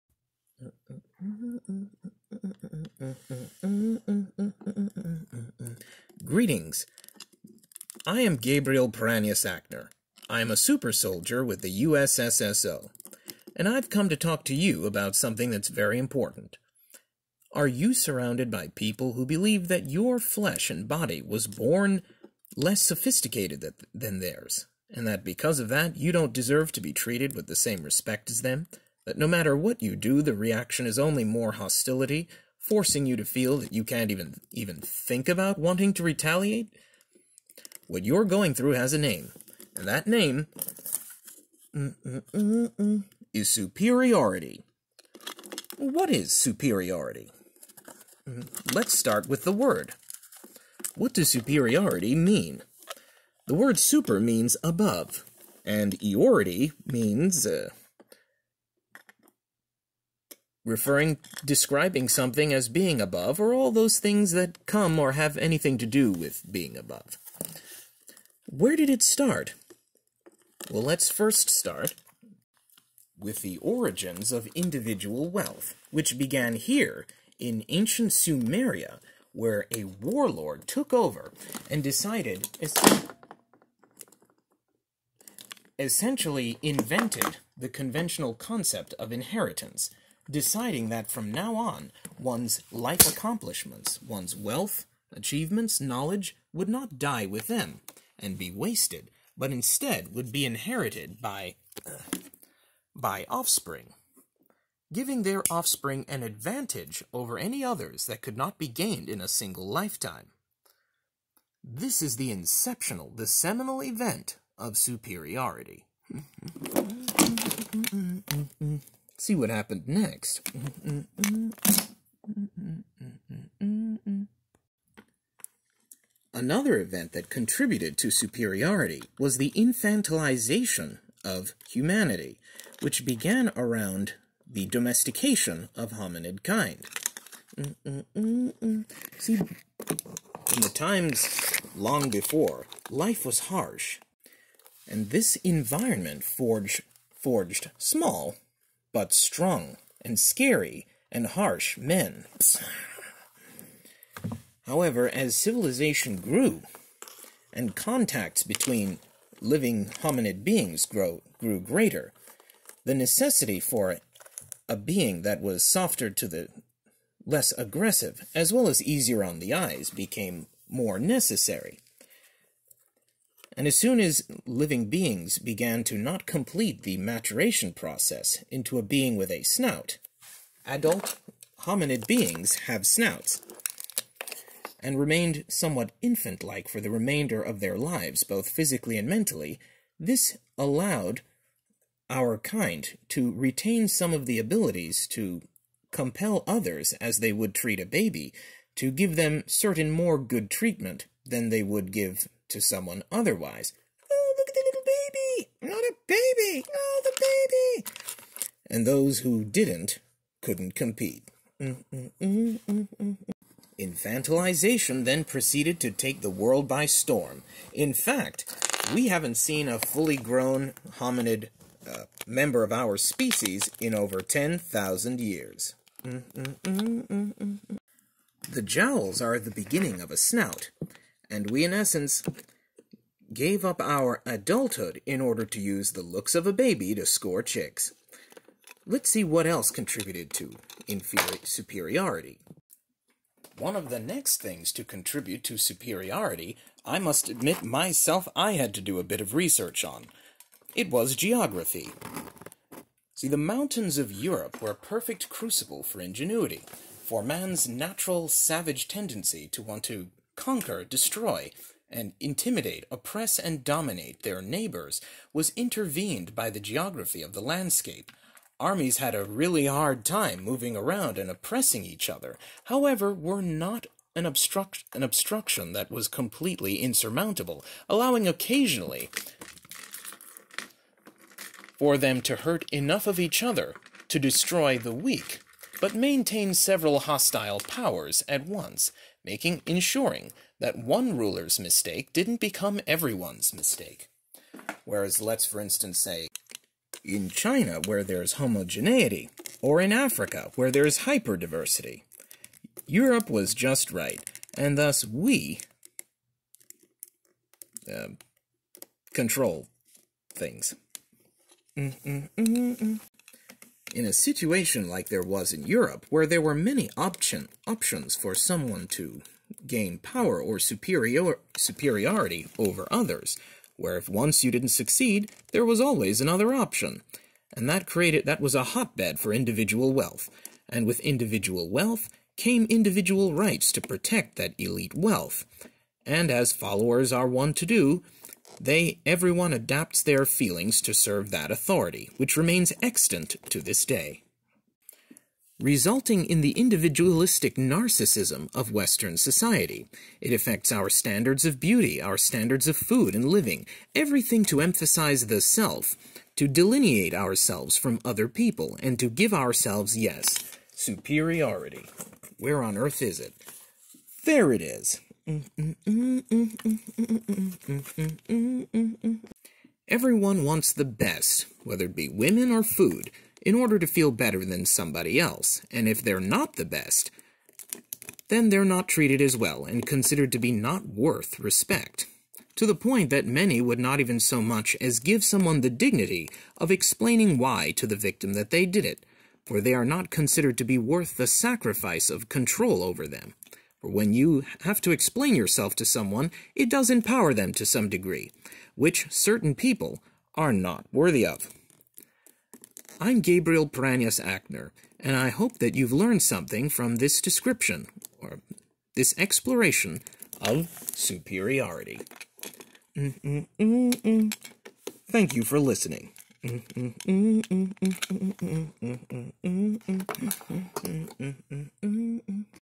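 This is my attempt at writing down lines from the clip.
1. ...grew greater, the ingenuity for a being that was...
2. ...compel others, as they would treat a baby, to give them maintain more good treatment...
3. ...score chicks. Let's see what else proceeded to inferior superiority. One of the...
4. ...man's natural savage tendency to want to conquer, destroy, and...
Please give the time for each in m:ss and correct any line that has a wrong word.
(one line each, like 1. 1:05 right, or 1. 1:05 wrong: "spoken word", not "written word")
1. 2:41 wrong: "necessity", not "ingenuity"
2. 3:15 wrong: "certain", not "maintain"
3. 3:57 wrong: "contributed", not "proceeded"
4. 4:17 right.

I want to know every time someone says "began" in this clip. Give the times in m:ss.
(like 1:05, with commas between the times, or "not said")
1:16, 2:13, 2:55.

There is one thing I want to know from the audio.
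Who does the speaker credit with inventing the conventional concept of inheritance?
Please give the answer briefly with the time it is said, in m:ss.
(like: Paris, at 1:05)
A warlord, at 1:19.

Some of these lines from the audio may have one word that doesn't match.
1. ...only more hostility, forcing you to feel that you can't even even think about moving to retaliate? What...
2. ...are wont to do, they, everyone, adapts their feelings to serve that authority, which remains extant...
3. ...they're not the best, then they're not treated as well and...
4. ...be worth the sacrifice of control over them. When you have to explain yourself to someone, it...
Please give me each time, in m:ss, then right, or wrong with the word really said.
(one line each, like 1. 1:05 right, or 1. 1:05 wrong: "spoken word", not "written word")
1. 0:30 wrong: "wanting", not "moving"
2. 5:37 right
3. 6:16 right
4. 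6:30 right.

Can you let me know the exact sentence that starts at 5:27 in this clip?
And that created that was a hotbed for individual wealth.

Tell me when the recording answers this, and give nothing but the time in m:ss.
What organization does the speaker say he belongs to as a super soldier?
0:11.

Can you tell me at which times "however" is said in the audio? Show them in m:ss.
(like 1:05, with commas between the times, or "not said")
2:34, 4:32.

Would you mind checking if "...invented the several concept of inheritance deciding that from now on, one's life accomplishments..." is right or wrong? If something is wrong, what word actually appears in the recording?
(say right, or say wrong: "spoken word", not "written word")
wrong: "conventional", not "several".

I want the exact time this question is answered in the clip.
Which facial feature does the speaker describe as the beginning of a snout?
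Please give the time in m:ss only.
3:46.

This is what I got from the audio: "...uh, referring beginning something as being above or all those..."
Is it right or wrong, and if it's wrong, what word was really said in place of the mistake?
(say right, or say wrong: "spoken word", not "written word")
wrong: "describing", not "beginning".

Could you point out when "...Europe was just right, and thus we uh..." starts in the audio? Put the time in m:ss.
5:02.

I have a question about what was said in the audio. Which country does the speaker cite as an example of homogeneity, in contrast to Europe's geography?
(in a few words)
China.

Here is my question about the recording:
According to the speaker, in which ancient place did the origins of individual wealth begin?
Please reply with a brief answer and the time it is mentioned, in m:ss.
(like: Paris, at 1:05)
Sumeria, at 1:17.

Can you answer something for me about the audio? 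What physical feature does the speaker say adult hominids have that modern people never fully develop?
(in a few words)
Snouts.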